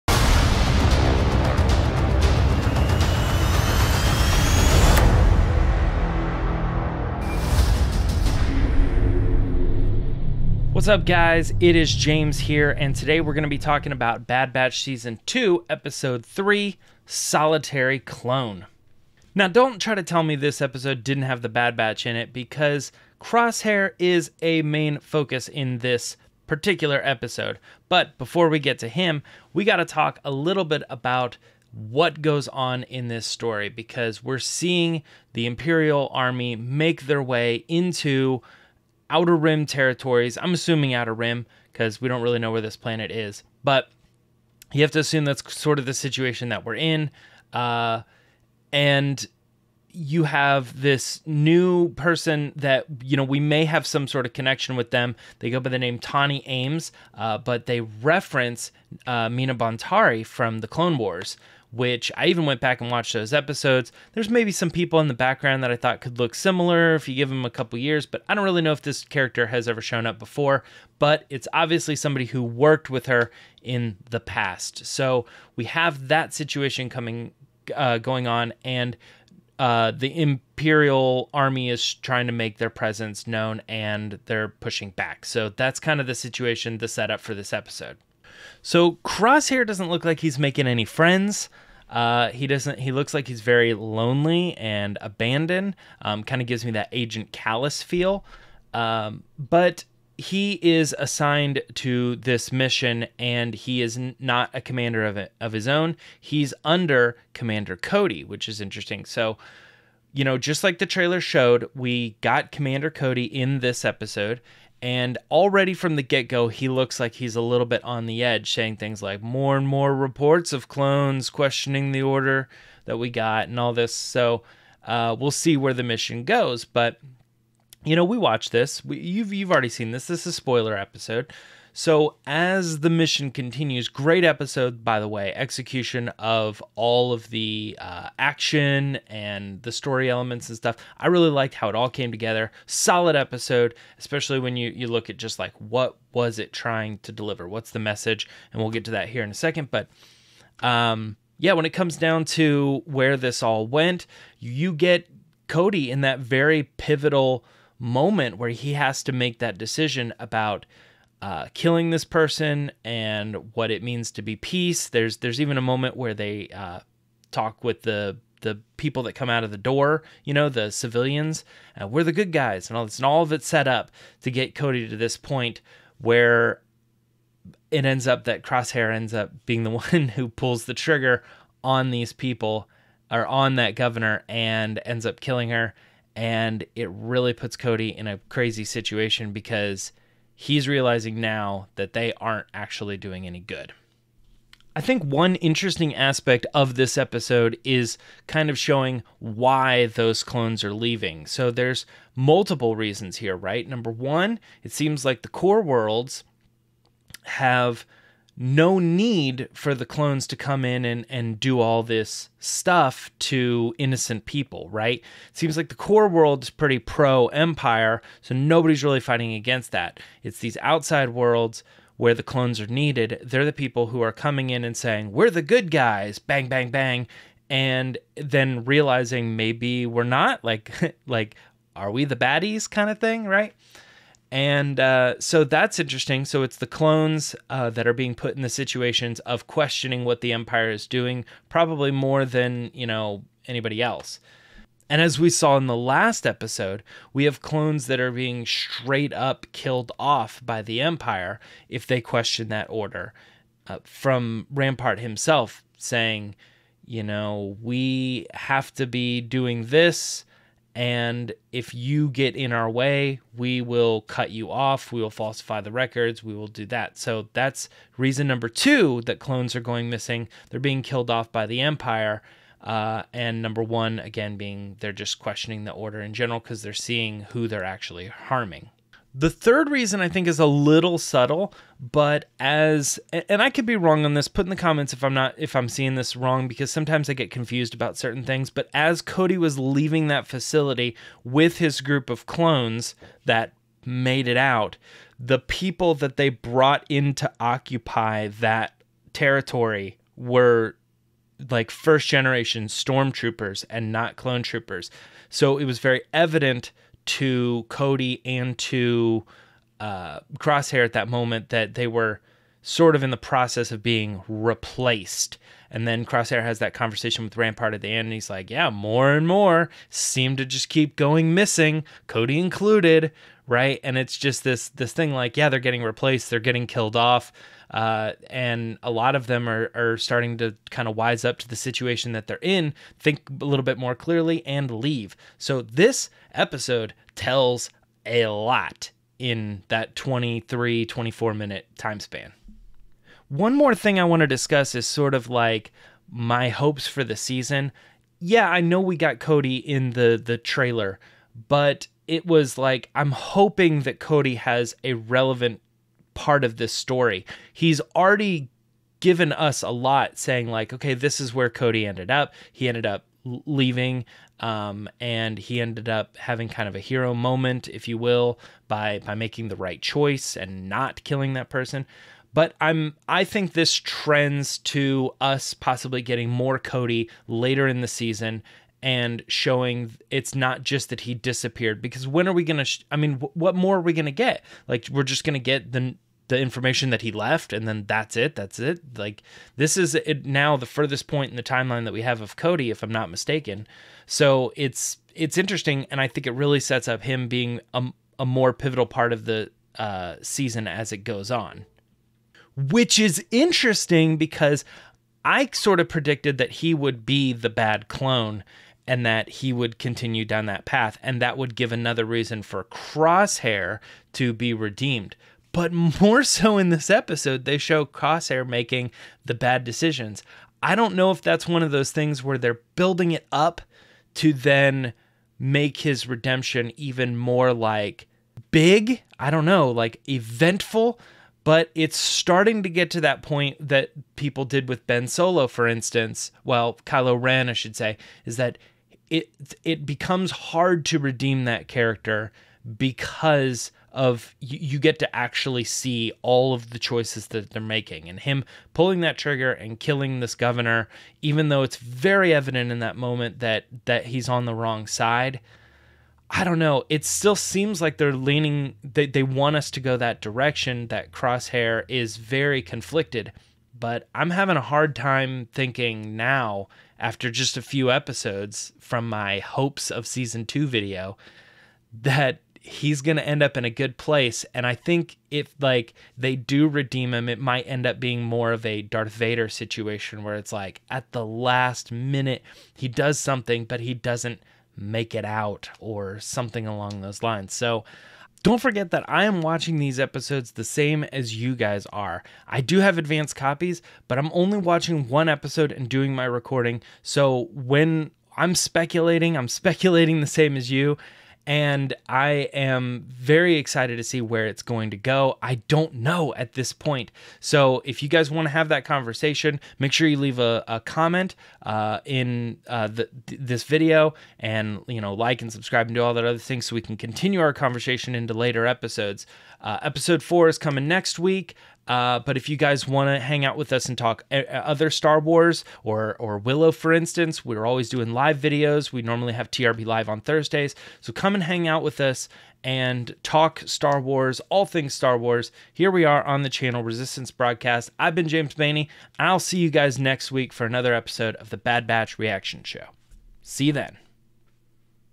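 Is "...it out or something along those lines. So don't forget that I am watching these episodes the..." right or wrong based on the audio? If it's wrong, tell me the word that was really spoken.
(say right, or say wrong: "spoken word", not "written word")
right.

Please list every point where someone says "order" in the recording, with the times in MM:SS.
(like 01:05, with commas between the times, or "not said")
02:02, 04:12, 04:35.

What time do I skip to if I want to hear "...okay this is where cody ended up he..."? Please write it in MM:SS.
06:00.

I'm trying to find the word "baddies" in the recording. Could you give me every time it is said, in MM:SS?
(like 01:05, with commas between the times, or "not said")
03:52.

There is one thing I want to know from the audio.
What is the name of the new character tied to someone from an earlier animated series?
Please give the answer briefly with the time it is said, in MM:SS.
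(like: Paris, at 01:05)
Tawni Ames, at 00:55.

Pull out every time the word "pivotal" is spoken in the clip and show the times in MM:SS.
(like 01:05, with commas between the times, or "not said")
02:36, 06:38.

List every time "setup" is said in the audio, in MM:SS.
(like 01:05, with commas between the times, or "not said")
01:26.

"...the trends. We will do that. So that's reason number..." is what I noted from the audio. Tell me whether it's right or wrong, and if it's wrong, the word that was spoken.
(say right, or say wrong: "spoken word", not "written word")
wrong: "records", not "trends".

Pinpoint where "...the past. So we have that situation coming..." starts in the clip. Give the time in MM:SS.
01:14.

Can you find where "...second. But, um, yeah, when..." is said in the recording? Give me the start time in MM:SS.
02:29.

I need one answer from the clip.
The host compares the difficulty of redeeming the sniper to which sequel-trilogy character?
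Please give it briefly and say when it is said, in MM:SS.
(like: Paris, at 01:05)
Ben Solo, at 07:14.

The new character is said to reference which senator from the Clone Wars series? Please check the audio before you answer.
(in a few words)
Mina Bonteri.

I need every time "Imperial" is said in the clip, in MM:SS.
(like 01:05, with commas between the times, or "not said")
00:35, 01:20.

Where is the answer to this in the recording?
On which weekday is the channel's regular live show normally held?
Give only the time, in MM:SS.
08:50.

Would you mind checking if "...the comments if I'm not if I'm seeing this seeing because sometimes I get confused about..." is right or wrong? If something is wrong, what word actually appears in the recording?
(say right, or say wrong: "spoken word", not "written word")
wrong: "wrong", not "seeing".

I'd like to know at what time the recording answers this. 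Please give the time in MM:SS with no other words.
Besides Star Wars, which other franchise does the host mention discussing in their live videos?
08:46.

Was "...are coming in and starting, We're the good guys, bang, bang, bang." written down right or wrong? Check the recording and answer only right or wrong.
wrong.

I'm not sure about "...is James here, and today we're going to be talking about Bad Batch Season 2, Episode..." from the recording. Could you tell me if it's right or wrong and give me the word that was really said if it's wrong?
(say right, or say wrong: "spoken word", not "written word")
right.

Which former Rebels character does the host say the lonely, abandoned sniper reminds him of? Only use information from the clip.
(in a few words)
Agent Kallus.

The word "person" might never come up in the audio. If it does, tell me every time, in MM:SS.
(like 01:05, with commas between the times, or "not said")
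00:51, 02:42, 06:11.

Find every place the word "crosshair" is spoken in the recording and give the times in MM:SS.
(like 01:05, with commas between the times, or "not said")
00:23, 01:29, 02:58, 05:10, 05:16, 06:52, 06:57, 07:41.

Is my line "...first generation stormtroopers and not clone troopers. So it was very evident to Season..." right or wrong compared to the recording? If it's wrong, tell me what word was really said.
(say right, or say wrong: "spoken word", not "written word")
wrong: "Cody", not "Season".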